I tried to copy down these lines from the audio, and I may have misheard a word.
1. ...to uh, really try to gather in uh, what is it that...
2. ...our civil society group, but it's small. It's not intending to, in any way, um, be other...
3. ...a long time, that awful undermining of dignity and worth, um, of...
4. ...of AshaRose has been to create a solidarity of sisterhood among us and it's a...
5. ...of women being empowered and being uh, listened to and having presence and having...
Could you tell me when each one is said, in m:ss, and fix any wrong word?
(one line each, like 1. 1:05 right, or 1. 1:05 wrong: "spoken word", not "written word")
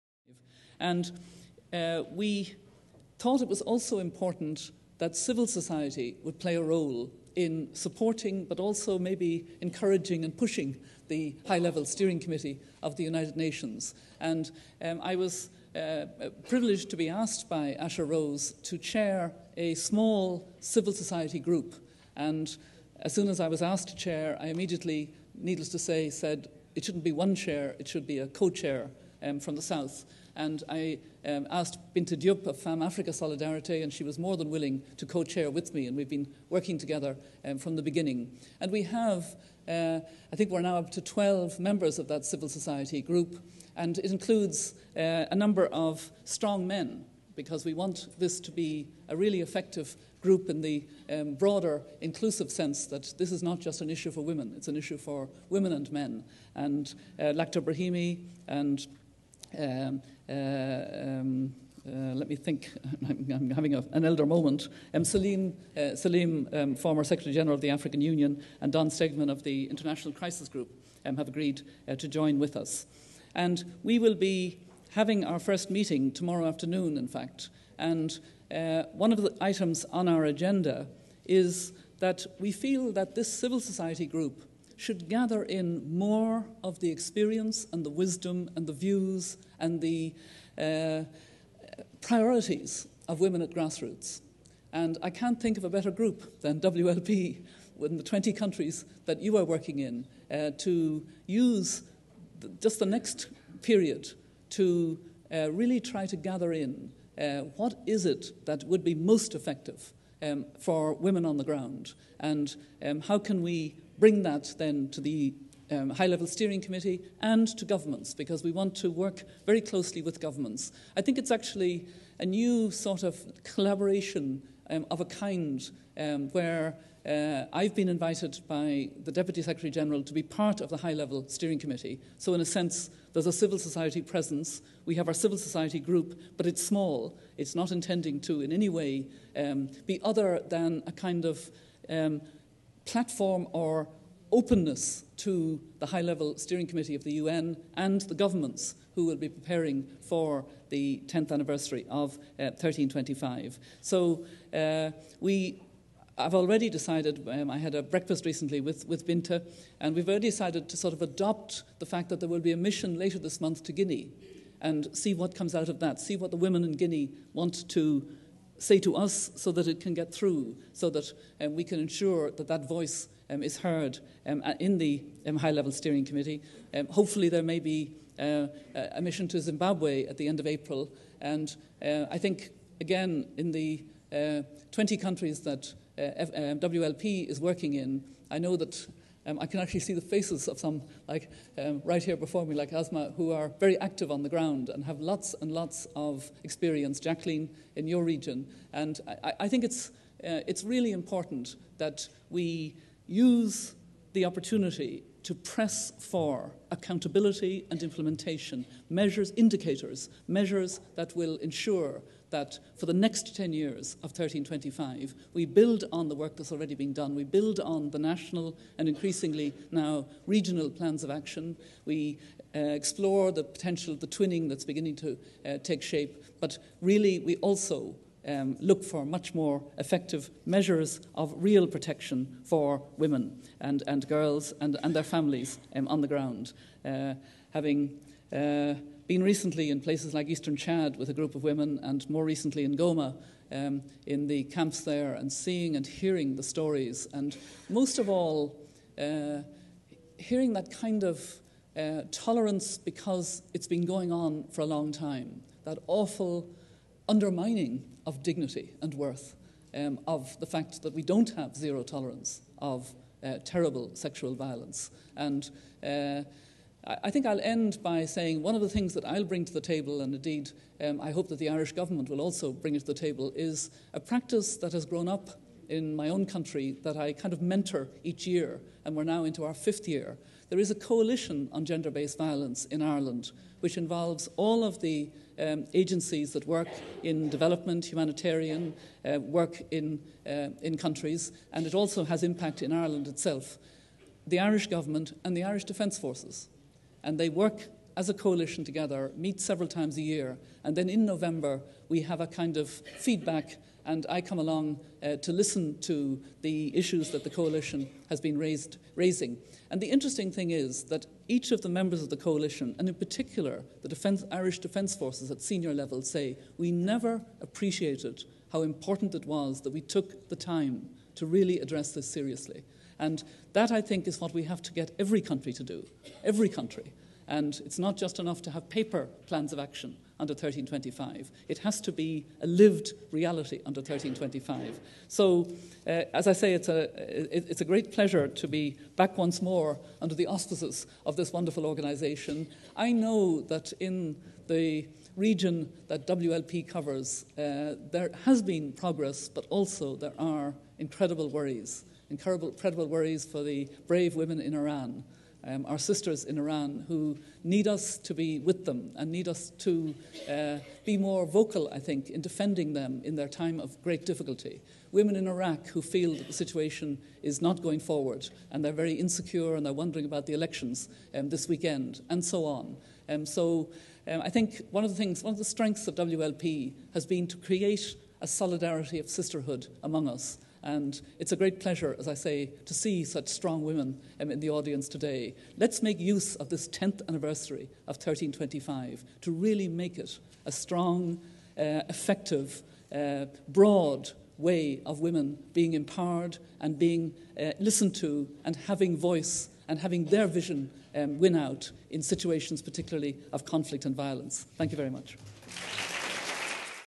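1. 1:44 right
2. 2:15 right
3. 4:14 right
4. 6:15 wrong: "WLP", not "AshaRose"
5. 6:34 wrong: "voice", not "presence".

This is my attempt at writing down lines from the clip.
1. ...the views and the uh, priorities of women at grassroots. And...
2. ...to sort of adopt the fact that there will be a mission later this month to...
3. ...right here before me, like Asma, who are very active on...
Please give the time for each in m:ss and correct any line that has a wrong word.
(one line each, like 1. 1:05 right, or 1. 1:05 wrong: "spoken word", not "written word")
1. 1:28 right
2. 2:40 right
3. 3:11 right.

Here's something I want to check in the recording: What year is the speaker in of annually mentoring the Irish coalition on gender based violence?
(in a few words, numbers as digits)
fifth year.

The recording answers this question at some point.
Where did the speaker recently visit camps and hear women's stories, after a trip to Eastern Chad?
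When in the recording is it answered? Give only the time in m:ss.
4:02.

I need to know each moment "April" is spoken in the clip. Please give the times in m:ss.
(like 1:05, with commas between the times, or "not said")
3:00.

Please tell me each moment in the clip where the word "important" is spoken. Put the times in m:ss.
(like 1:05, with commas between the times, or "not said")
0:03, 3:20, 5:18.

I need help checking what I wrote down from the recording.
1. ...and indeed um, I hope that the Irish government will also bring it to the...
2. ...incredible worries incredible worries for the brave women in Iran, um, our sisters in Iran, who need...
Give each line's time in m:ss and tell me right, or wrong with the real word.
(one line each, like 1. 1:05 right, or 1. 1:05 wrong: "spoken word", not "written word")
1. 4:30 right
2. 5:50 right.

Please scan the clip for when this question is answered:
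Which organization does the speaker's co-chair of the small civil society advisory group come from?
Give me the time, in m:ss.
0:32.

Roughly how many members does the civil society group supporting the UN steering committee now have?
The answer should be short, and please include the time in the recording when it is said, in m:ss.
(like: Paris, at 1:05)
12, at 0:41.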